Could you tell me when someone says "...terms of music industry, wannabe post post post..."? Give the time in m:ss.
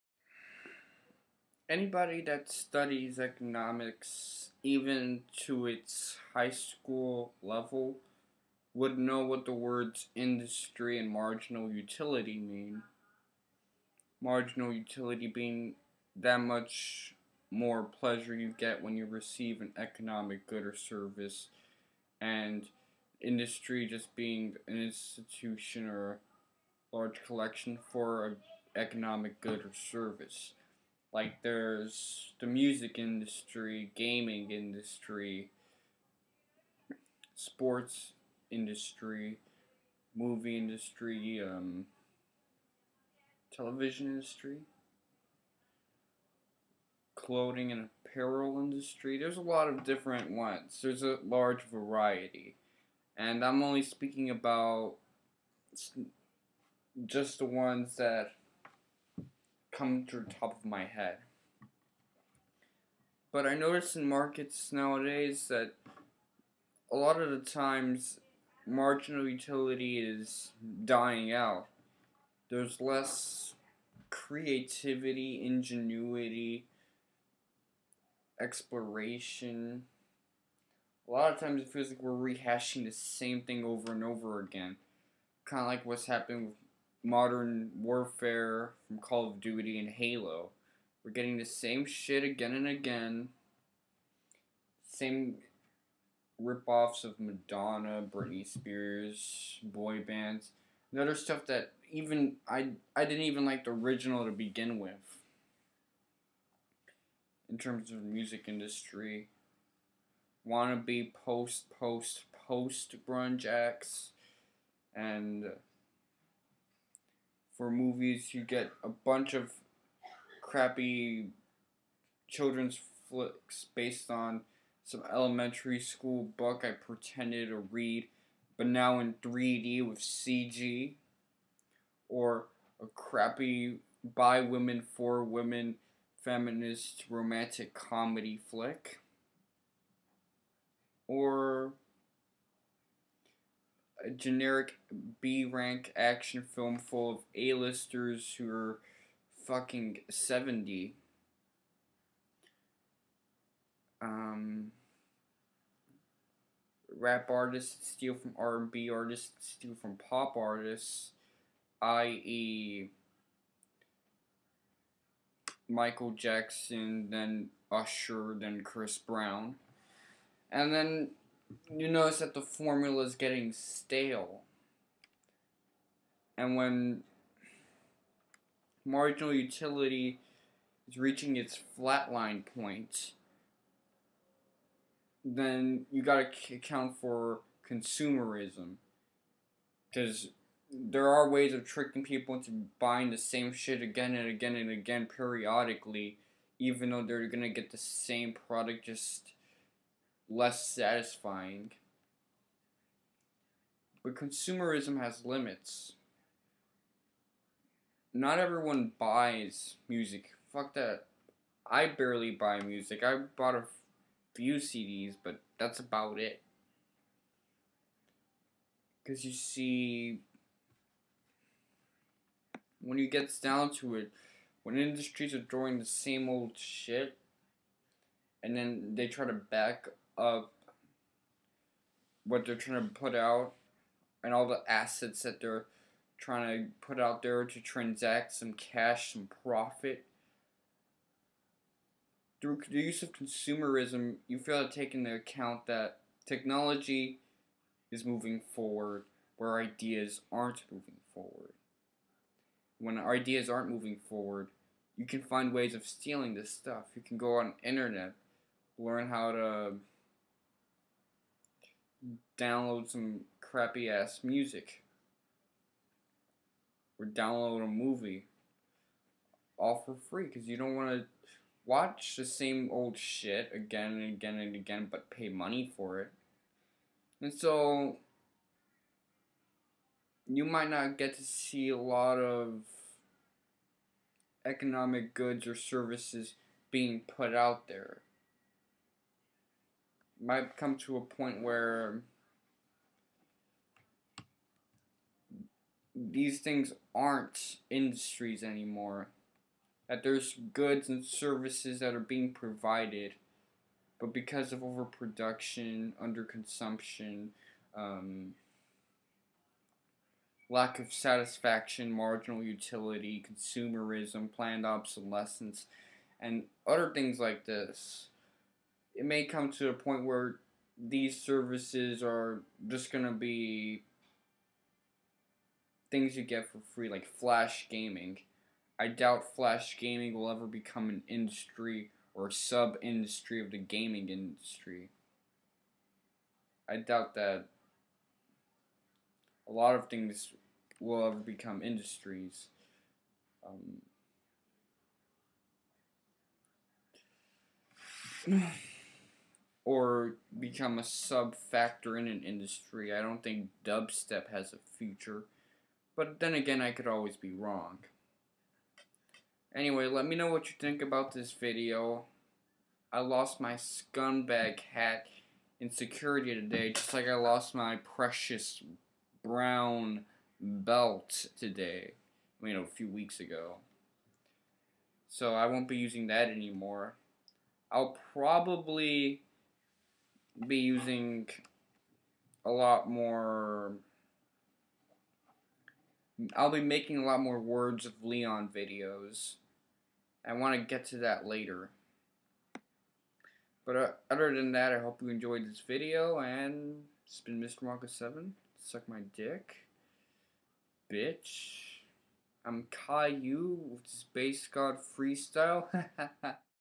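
1:47.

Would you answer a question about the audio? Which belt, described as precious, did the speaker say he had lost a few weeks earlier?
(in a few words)
Brown belt.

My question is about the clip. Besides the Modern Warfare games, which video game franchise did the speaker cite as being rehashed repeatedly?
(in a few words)
Halo.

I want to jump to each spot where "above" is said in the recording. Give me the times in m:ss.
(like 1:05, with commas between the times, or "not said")
not said.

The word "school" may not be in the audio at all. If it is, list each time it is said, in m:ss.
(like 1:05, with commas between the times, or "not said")
0:06, 2:05.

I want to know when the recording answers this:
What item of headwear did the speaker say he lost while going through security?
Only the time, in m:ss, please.
6:03.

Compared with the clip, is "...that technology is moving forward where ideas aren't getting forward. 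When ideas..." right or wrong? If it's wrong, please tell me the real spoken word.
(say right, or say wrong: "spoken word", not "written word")
wrong: "moving", not "getting".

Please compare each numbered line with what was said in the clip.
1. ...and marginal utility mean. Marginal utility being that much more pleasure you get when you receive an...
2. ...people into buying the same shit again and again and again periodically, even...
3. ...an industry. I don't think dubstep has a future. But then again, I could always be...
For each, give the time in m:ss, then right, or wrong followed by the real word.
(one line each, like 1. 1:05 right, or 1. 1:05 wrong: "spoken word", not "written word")
1. 0:10 right
2. 3:12 right
3. 5:52 right.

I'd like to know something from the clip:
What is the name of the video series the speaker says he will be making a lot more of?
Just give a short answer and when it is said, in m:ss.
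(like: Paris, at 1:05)
Words of Leon, at 6:27.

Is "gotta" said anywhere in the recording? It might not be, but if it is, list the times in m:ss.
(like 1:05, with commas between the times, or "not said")
3:06.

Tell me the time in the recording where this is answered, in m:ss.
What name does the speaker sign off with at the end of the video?
6:37.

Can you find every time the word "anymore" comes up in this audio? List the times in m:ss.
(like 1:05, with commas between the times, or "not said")
4:58, 6:16.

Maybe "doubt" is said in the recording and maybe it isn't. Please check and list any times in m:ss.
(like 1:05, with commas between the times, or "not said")
5:28, 5:36.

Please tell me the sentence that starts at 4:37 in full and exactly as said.
And so you might not get to see a lot of economic goods or services being put out there.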